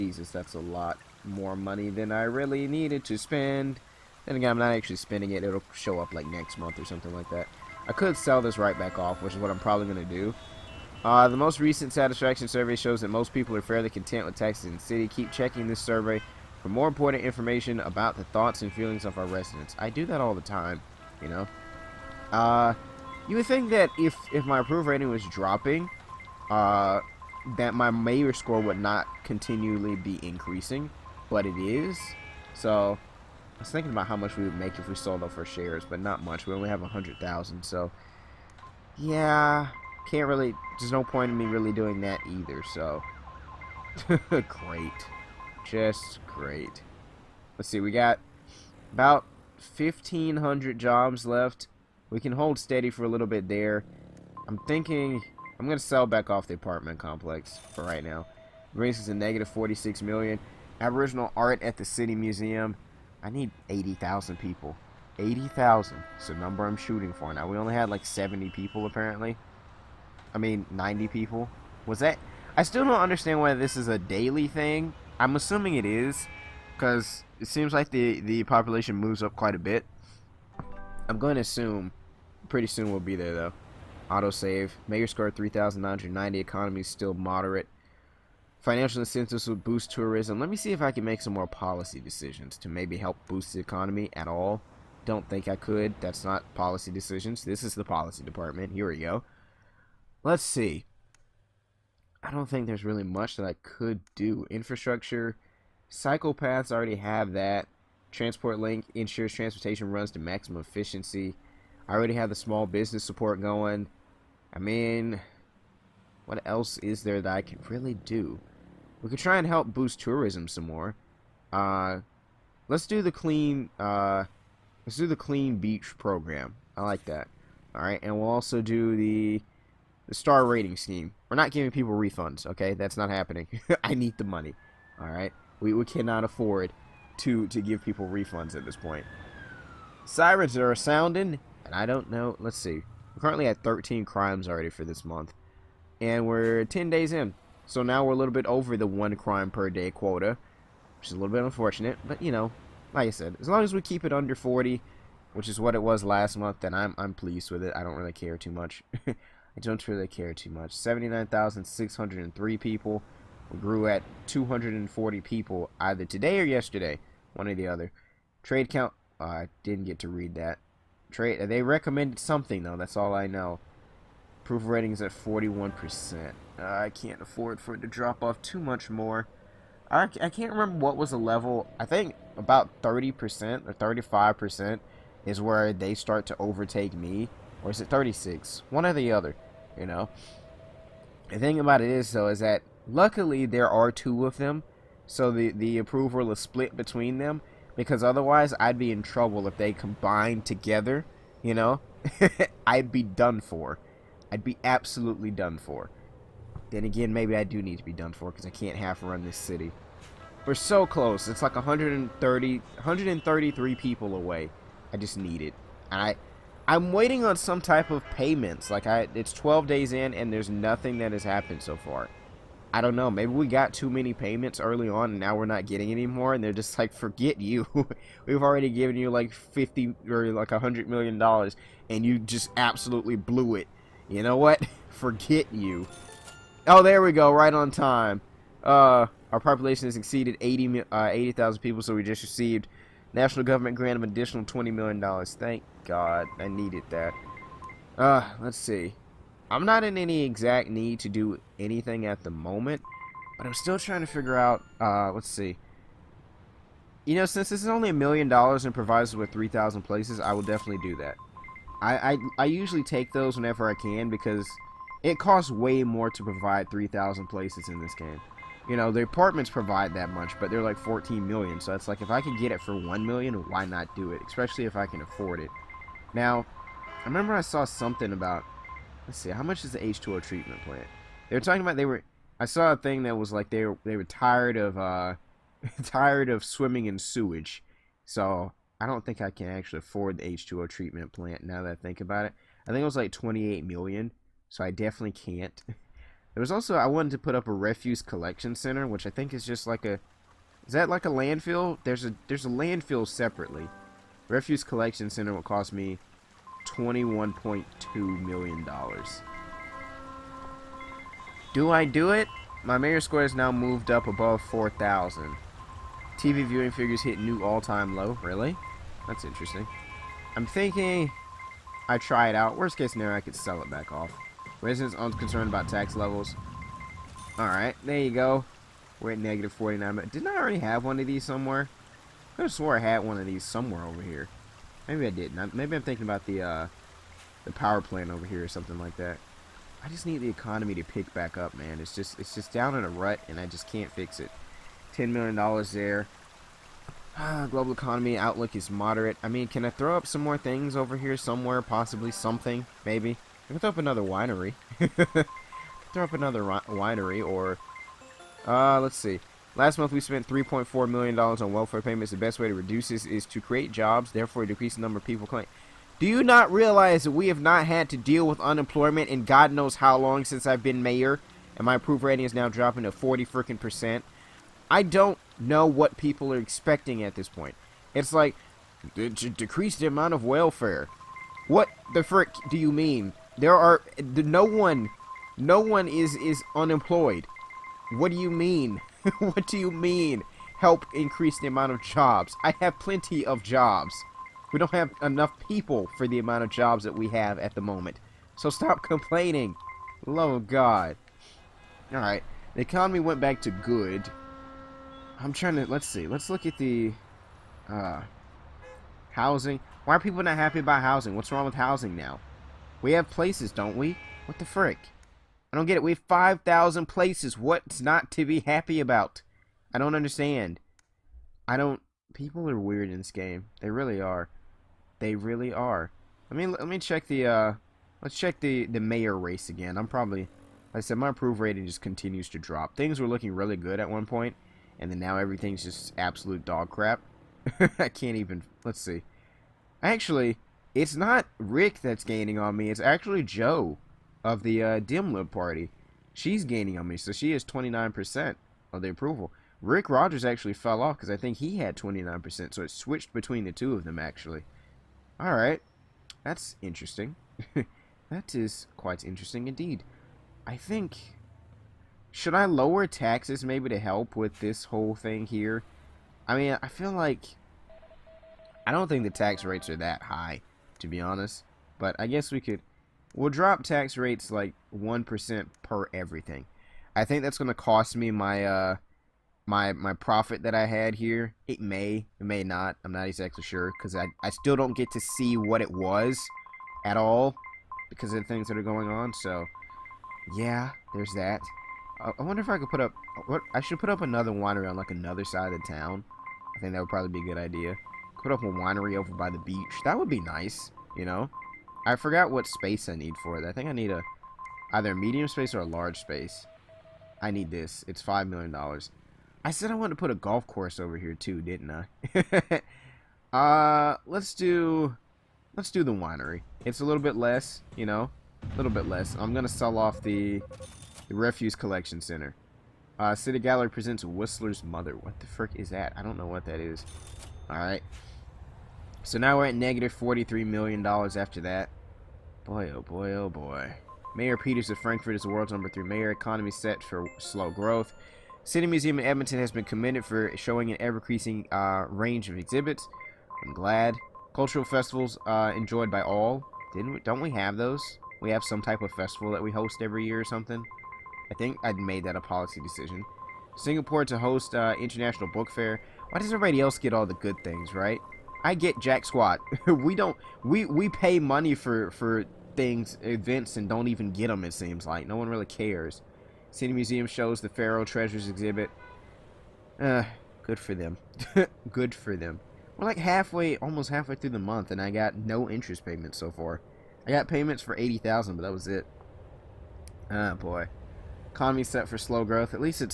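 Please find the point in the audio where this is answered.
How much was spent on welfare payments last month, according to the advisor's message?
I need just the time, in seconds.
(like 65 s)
360 s.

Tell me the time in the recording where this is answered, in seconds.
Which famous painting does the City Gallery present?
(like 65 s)
524 s.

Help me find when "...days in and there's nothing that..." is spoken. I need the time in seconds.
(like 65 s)
219 s.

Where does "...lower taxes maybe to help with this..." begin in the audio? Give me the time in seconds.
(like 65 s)
462 s.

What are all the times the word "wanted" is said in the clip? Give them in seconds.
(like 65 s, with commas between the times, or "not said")
296 s, 509 s.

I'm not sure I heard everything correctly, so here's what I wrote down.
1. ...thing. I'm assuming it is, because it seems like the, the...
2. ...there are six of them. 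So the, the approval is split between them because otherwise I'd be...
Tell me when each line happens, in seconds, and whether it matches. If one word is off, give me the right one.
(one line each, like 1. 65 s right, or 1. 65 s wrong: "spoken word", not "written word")
1. 74 s right
2. 193 s wrong: "two", not "six".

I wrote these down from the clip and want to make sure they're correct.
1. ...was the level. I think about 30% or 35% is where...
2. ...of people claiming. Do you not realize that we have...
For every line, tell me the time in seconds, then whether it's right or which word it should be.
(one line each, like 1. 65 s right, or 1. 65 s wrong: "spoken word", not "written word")
1. 180 s right
2. 364 s right.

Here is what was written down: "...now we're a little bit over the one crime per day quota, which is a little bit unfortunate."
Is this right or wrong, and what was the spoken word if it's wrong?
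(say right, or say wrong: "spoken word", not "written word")
right.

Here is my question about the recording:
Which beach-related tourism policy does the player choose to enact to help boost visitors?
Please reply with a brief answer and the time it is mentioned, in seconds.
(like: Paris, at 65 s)
clean beach program, at 125 s.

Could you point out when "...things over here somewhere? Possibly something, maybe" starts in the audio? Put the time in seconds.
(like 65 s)
350 s.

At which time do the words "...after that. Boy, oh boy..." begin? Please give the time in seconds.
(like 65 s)
530 s.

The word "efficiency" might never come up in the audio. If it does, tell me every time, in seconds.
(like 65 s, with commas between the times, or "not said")
110 s.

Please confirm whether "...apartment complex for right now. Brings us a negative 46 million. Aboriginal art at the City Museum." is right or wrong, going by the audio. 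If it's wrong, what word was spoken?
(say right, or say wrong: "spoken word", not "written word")
right.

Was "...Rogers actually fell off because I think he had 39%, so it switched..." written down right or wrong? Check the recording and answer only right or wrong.
wrong.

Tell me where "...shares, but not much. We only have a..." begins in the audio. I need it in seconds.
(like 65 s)
35 s.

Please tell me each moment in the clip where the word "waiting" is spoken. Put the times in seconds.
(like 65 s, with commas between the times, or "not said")
216 s.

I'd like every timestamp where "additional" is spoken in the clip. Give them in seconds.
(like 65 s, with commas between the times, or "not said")
244 s.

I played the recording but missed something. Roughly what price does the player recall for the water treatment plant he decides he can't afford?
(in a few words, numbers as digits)
28 million.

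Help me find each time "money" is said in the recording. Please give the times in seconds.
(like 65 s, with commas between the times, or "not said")
1 s, 134 s, 561 s.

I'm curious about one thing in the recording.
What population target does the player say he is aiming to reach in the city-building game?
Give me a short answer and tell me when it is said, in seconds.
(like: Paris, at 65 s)
80,000, at 65 s.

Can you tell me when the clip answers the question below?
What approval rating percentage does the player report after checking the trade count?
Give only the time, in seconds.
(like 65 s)
175 s.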